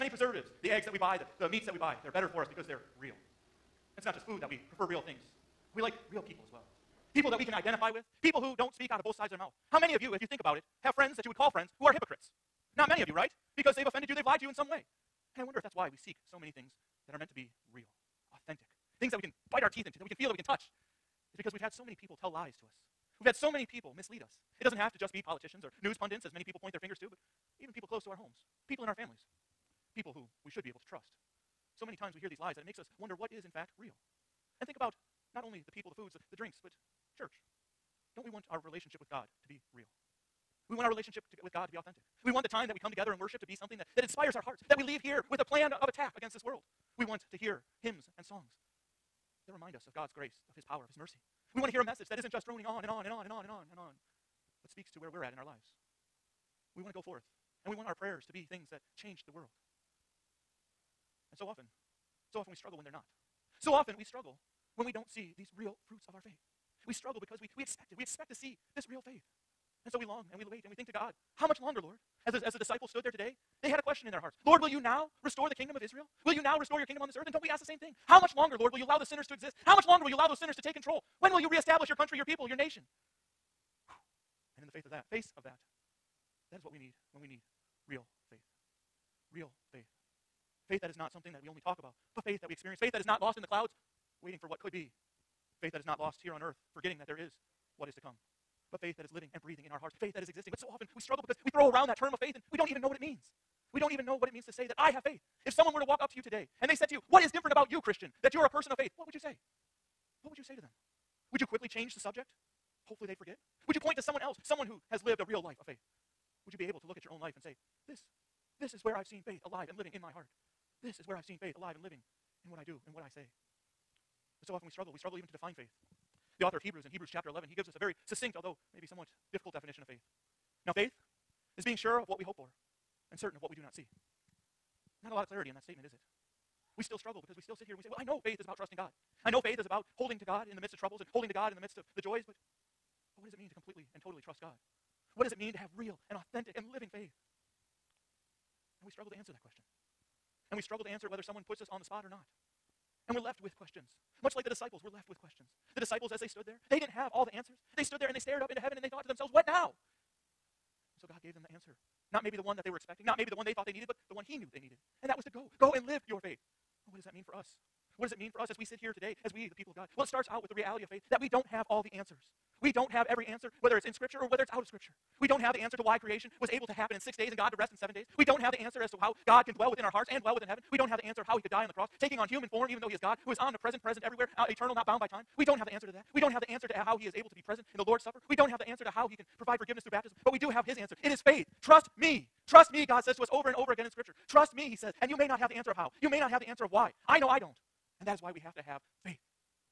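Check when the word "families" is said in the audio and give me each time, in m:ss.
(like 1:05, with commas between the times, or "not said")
0:28.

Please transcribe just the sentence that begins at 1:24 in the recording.
And in the faith of that, face of that, that is what we need when we need real real faith.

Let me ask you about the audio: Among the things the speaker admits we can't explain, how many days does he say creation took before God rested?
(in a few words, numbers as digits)
6.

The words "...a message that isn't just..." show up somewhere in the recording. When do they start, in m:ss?
0:51.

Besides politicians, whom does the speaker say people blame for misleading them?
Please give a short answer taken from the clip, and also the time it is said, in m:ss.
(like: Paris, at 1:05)
news pundits, at 0:25.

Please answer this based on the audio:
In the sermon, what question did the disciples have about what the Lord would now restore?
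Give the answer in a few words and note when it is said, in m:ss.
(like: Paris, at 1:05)
the kingdom of Israel, at 1:15.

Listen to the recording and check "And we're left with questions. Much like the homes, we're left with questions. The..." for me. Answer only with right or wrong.
wrong.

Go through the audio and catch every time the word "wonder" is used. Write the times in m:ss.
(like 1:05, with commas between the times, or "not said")
0:15, 0:32.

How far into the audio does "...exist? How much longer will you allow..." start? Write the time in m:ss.
1:19.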